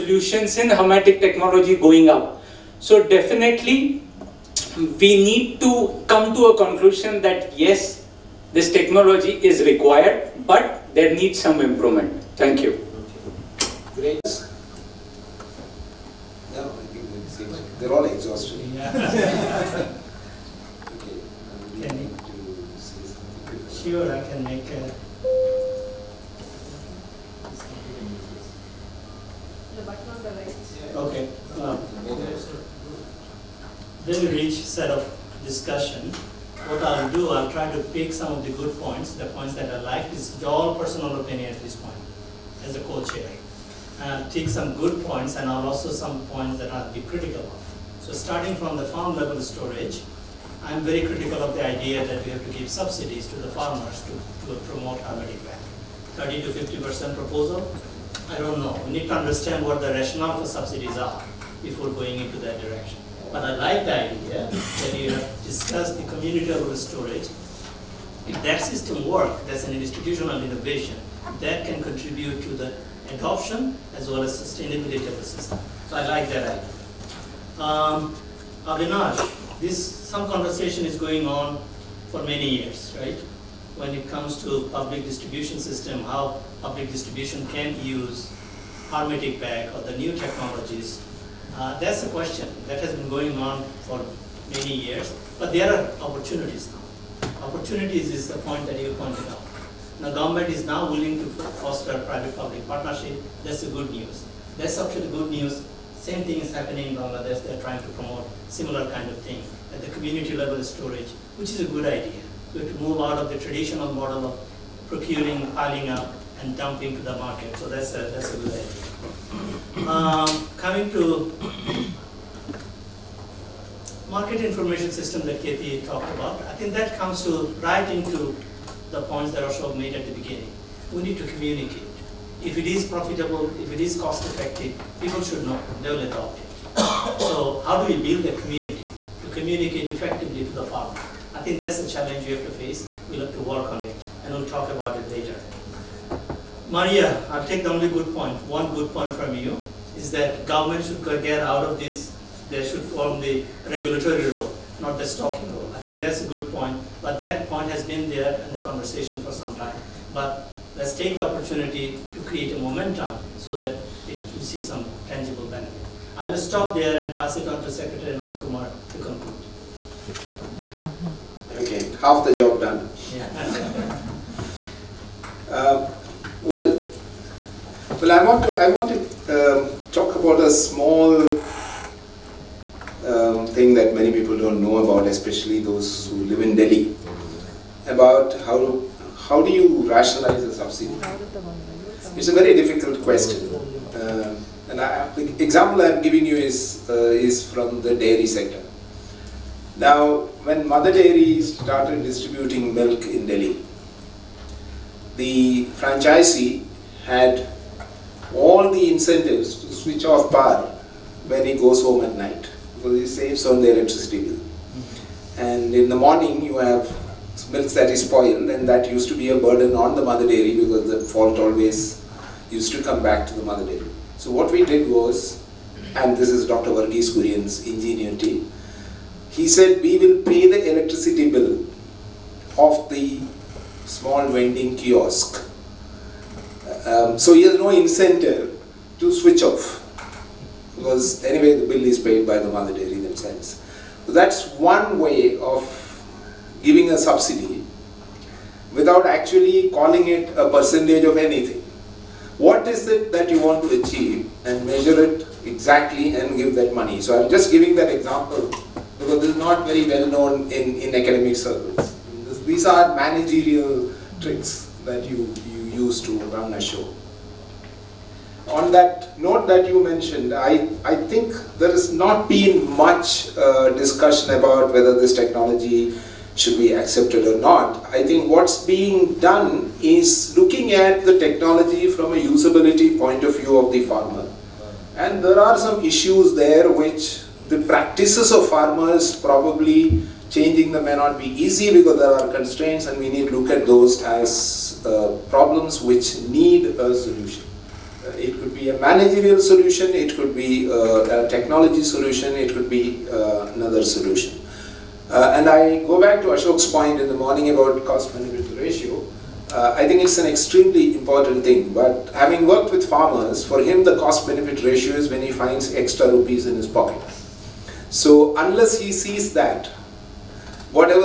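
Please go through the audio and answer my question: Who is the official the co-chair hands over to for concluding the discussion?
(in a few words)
Ram Kumar.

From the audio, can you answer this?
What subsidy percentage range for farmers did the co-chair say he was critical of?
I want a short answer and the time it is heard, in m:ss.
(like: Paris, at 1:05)
30 to 50%, at 0:56.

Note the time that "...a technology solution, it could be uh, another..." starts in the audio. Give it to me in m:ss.
5:01.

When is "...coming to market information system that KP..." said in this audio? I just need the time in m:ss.
2:00.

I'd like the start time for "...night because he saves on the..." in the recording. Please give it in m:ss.
3:32.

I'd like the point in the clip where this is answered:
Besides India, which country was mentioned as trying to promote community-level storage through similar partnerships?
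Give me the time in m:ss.
1:46.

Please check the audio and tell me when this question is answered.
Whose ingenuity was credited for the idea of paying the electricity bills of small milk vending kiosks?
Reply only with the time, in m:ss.
3:46.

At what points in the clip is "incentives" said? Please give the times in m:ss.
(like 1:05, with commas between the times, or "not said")
3:28, 3:57.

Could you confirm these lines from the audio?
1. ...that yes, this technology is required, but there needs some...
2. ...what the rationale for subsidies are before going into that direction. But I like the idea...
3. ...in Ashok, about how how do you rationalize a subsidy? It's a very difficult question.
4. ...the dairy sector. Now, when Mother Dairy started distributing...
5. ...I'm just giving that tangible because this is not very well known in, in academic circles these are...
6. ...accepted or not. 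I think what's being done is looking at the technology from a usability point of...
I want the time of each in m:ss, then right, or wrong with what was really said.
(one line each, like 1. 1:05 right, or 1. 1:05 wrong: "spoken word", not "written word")
1. 0:07 right
2. 0:59 right
3. 3:06 wrong: "Delhi", not "Ashok"
4. 3:17 right
5. 4:17 wrong: "example", not "tangible"
6. 4:36 right.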